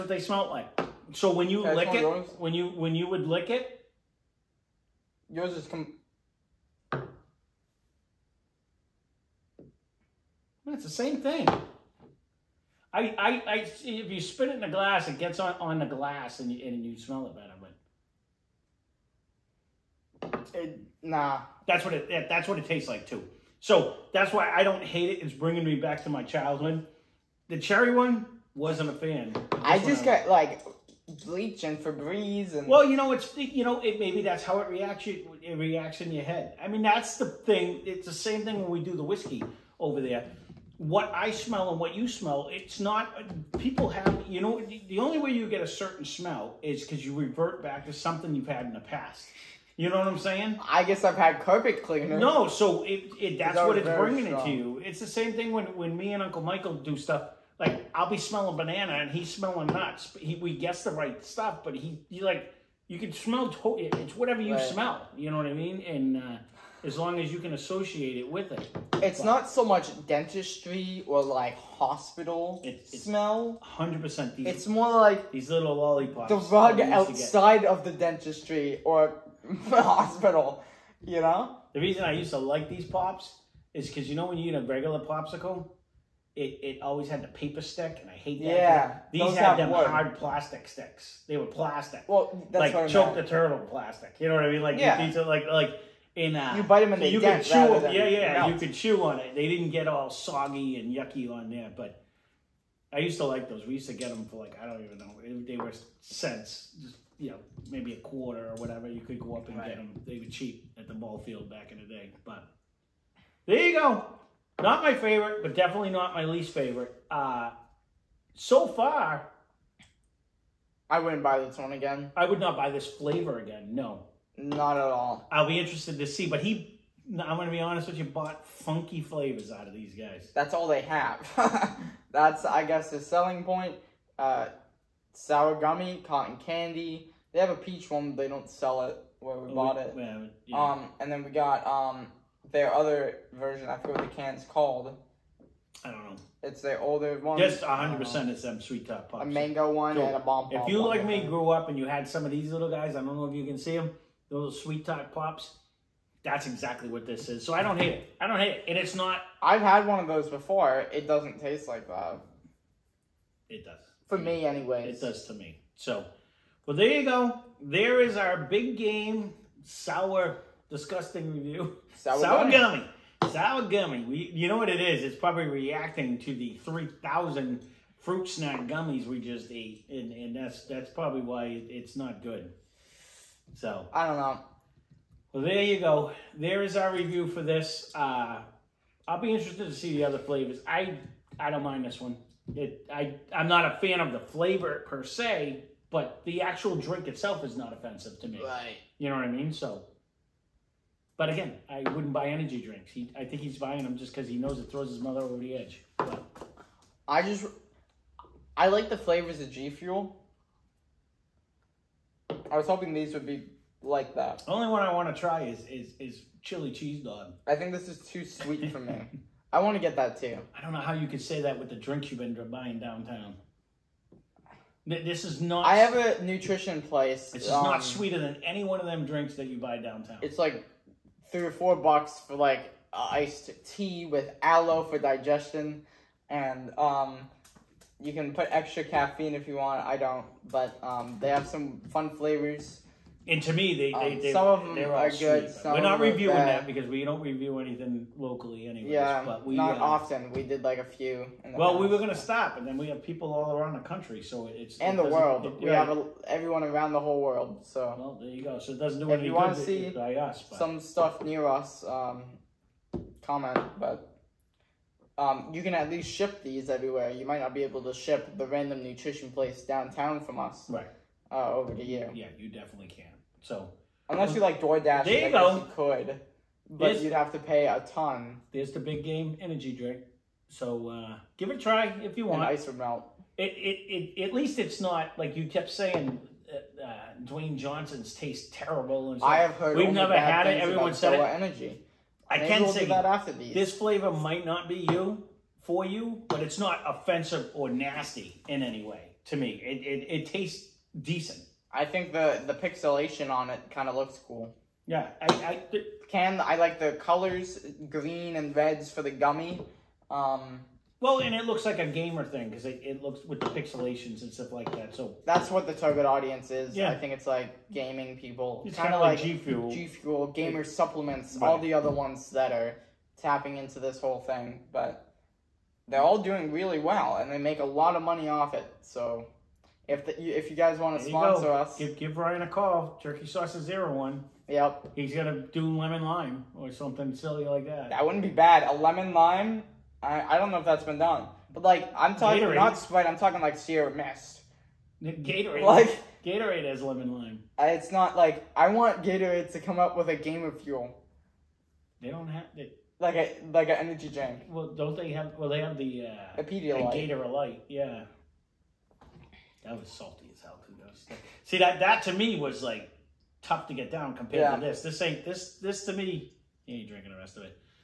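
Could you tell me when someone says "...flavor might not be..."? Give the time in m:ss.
4:53.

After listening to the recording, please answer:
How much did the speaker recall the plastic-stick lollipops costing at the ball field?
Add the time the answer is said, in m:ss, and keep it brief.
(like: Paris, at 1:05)
a quarter, at 1:47.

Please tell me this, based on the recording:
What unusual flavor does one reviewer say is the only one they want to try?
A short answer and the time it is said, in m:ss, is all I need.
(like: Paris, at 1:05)
chili cheese dog, at 3:36.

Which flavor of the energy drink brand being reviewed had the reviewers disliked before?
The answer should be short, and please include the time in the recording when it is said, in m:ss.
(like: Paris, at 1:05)
Cherry, at 0:27.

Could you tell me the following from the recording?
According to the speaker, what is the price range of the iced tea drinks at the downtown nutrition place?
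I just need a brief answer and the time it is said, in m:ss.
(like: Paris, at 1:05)
3 or 4 bucks, at 3:51.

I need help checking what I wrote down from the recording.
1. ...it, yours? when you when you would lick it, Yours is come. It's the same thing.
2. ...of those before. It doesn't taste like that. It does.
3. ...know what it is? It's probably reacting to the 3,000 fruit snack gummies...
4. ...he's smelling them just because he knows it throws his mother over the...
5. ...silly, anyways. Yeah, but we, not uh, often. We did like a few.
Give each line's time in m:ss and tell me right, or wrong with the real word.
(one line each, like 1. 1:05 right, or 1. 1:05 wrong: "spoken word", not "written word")
1. 0:01 right
2. 2:39 right
3. 2:54 right
4. 3:23 wrong: "buying", not "smelling"
5. 4:08 wrong: "locally", not "silly".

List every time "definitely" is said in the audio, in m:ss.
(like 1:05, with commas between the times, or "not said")
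1:55, 4:32.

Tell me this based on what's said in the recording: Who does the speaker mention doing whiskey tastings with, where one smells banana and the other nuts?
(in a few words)
Uncle Michael.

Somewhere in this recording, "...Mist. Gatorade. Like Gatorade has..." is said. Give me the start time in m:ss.
5:43.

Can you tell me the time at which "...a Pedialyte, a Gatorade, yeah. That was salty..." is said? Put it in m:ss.
5:56.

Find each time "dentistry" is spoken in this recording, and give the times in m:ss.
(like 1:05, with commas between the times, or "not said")
1:10, 1:17.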